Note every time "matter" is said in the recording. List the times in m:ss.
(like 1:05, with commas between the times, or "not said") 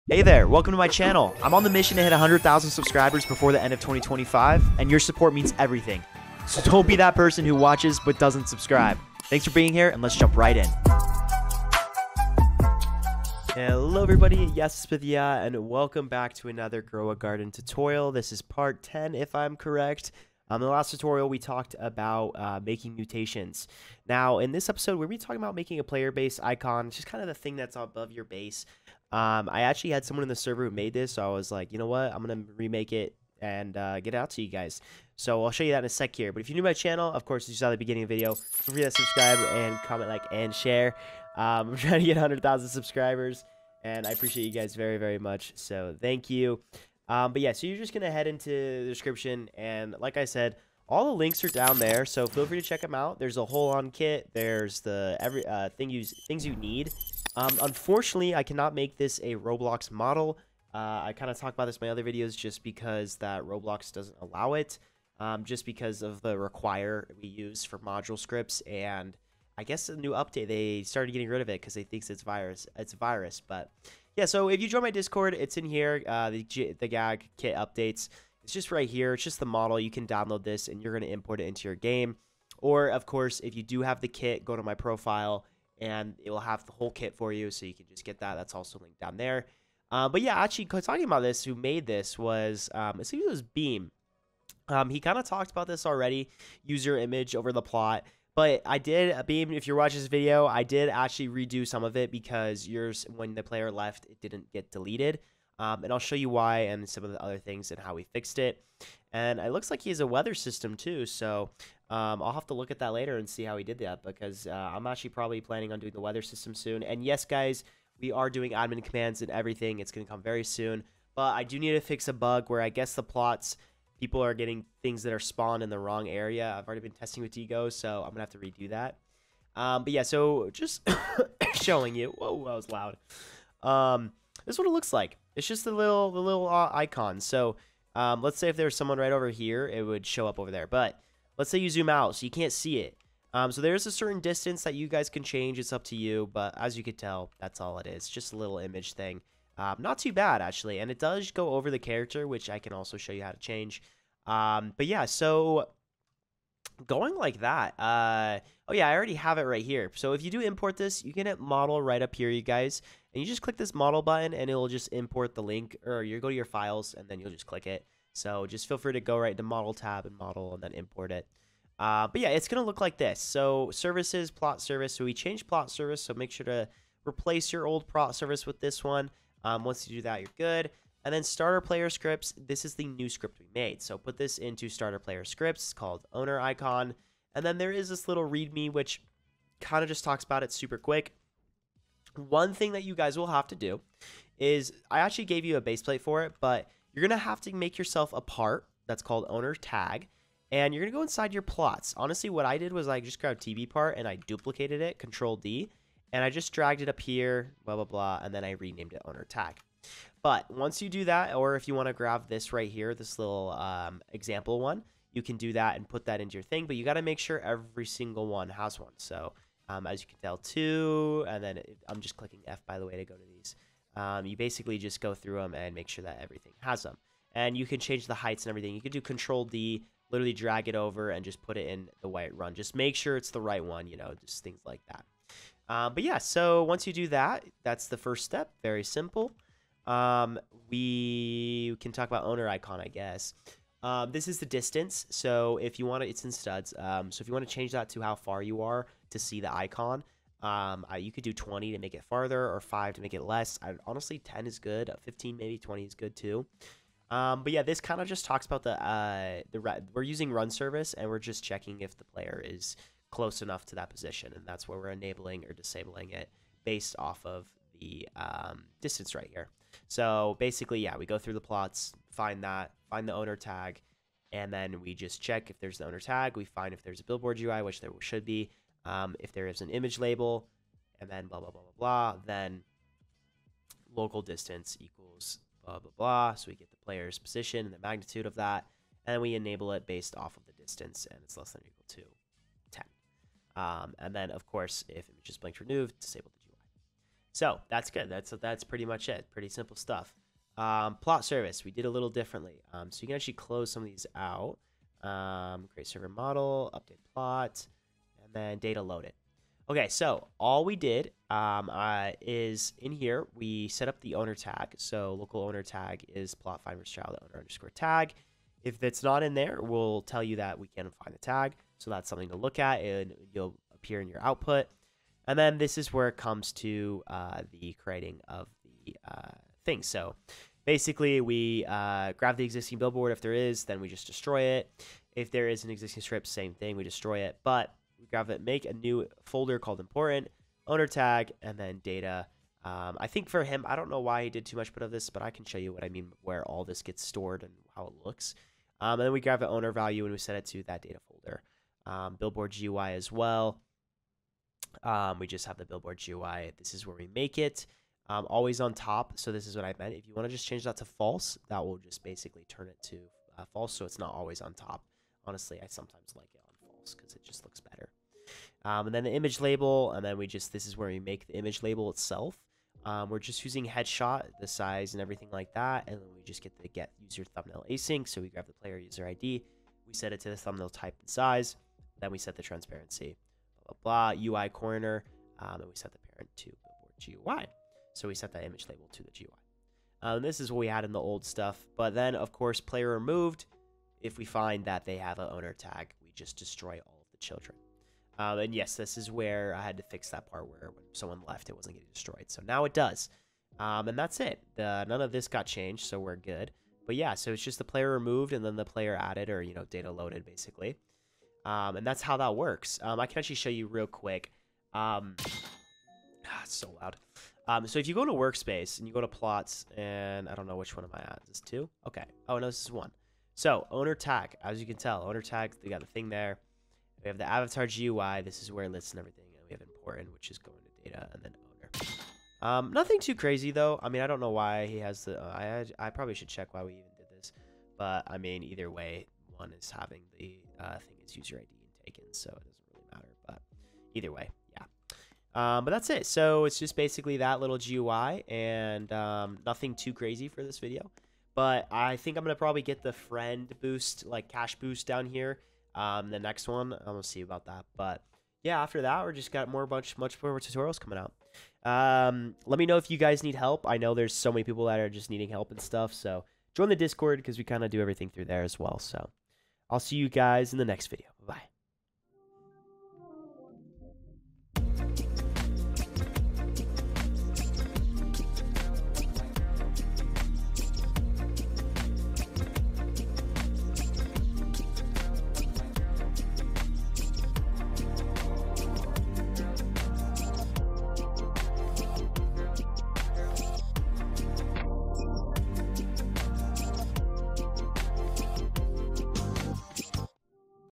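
7:22.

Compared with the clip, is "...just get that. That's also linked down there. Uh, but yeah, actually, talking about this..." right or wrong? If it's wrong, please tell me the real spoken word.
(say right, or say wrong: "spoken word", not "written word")
right.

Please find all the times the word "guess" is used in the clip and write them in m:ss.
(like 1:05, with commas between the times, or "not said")
1:09, 2:02, 4:02.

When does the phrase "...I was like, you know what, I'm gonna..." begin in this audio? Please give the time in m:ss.
0:31.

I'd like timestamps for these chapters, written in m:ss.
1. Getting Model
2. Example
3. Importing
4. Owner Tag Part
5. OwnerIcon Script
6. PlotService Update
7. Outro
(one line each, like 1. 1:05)
1. 1:00
2. 2:05
3. 2:30
4. 3:05
5. 4:00
6. 5:05
7. 6:56.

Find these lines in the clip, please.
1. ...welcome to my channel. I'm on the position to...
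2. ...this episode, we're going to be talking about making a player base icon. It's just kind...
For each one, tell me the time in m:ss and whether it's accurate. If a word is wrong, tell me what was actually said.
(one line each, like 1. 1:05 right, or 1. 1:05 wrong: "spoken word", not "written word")
1. 0:00 wrong: "mission", not "position"
2. 0:24 right.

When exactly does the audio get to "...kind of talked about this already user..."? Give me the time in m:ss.
1:35.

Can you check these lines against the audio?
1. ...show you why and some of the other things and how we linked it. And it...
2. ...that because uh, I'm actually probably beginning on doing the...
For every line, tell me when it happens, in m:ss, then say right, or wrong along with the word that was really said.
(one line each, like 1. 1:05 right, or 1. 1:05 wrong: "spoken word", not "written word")
1. 1:45 wrong: "fixed", not "linked"
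2. 1:53 wrong: "planning", not "beginning".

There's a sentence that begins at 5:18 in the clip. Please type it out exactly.
If that's not in there, we'll tell you that we can't find the tag.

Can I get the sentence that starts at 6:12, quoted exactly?
Um, we're just using headshot, the size and everything like that.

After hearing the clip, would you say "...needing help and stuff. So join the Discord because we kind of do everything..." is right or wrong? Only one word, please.
right.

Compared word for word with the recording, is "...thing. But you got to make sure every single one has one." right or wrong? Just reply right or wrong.
right.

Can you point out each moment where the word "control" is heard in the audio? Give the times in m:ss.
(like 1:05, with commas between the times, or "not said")
3:24, 3:49.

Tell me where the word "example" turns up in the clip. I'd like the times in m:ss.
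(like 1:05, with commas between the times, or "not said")
3:34.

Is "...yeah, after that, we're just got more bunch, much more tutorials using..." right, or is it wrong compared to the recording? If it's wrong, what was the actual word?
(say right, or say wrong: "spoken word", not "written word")
wrong: "coming", not "using".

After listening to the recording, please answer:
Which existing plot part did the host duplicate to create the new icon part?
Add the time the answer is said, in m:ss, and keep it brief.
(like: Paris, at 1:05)
TV part, at 3:22.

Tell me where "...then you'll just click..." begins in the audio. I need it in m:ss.
2:47.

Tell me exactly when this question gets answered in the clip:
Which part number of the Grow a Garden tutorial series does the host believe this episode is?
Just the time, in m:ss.
0:18.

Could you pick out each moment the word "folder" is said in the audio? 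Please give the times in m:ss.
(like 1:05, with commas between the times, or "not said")
5:39, 5:51.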